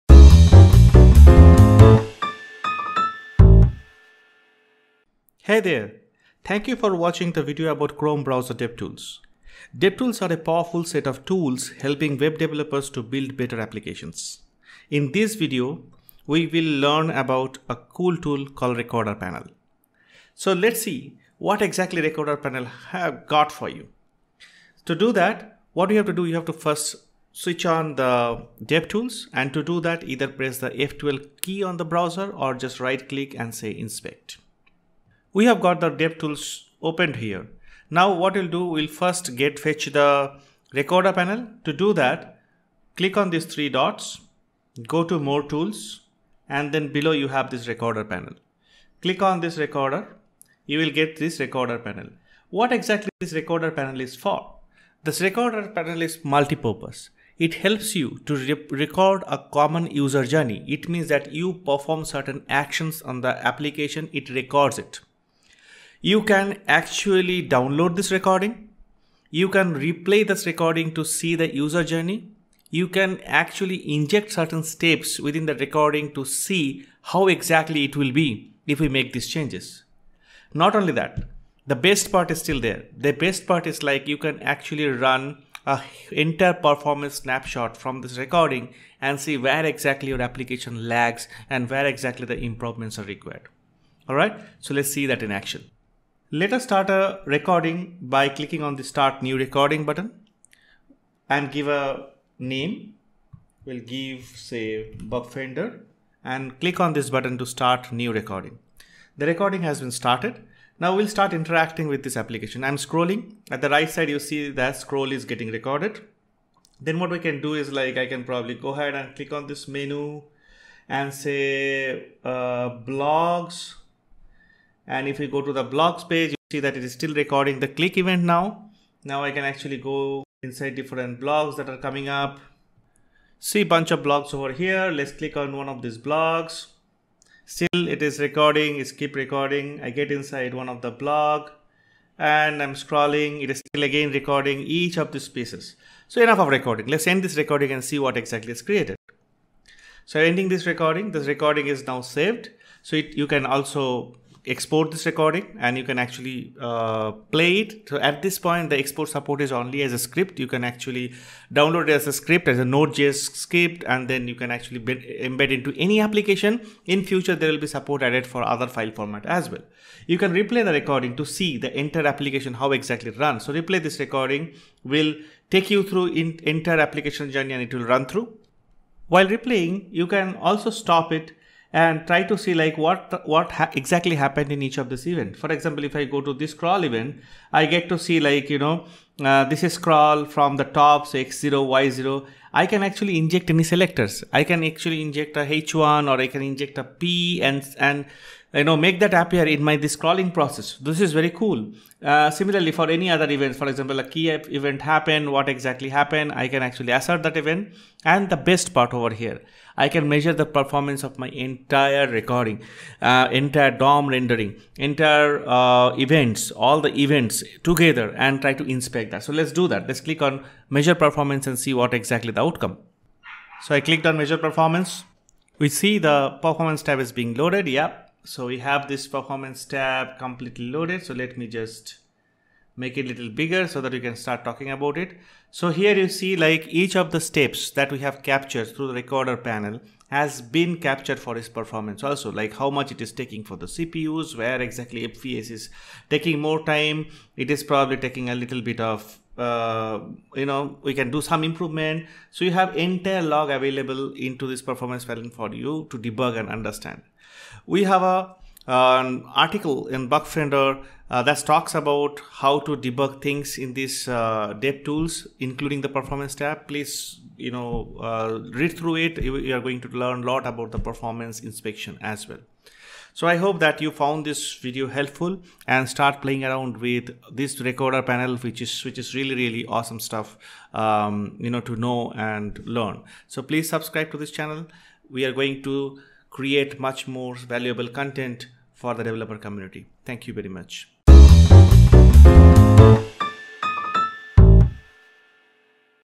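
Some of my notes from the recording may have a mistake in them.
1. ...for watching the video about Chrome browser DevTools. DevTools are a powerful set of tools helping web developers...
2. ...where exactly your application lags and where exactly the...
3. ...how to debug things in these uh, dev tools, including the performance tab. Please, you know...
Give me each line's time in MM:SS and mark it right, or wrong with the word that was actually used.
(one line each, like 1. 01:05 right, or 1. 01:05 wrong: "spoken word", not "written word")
1. 00:06 right
2. 01:29 right
3. 04:22 right.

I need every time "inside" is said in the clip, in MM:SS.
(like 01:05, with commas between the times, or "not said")
02:10, 02:20.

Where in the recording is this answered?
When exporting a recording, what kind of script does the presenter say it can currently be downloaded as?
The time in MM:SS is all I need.
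02:42.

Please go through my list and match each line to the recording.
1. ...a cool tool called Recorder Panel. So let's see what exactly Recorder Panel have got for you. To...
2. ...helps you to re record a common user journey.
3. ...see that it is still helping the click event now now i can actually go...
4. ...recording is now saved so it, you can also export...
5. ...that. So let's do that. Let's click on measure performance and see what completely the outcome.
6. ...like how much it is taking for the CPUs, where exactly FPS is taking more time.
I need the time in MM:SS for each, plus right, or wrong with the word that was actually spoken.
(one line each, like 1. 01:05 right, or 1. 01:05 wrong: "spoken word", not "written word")
1. 00:17 right
2. 00:57 right
3. 02:06 wrong: "recording", not "helping"
4. 02:31 right
5. 03:39 wrong: "exactly", not "completely"
6. 04:02 right.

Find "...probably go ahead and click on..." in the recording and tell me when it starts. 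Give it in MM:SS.
01:58.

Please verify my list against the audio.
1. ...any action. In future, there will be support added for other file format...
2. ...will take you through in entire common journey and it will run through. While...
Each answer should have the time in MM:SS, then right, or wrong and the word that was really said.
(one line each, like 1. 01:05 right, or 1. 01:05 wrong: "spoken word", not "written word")
1. 02:45 wrong: "application", not "action"
2. 02:54 wrong: "application", not "common".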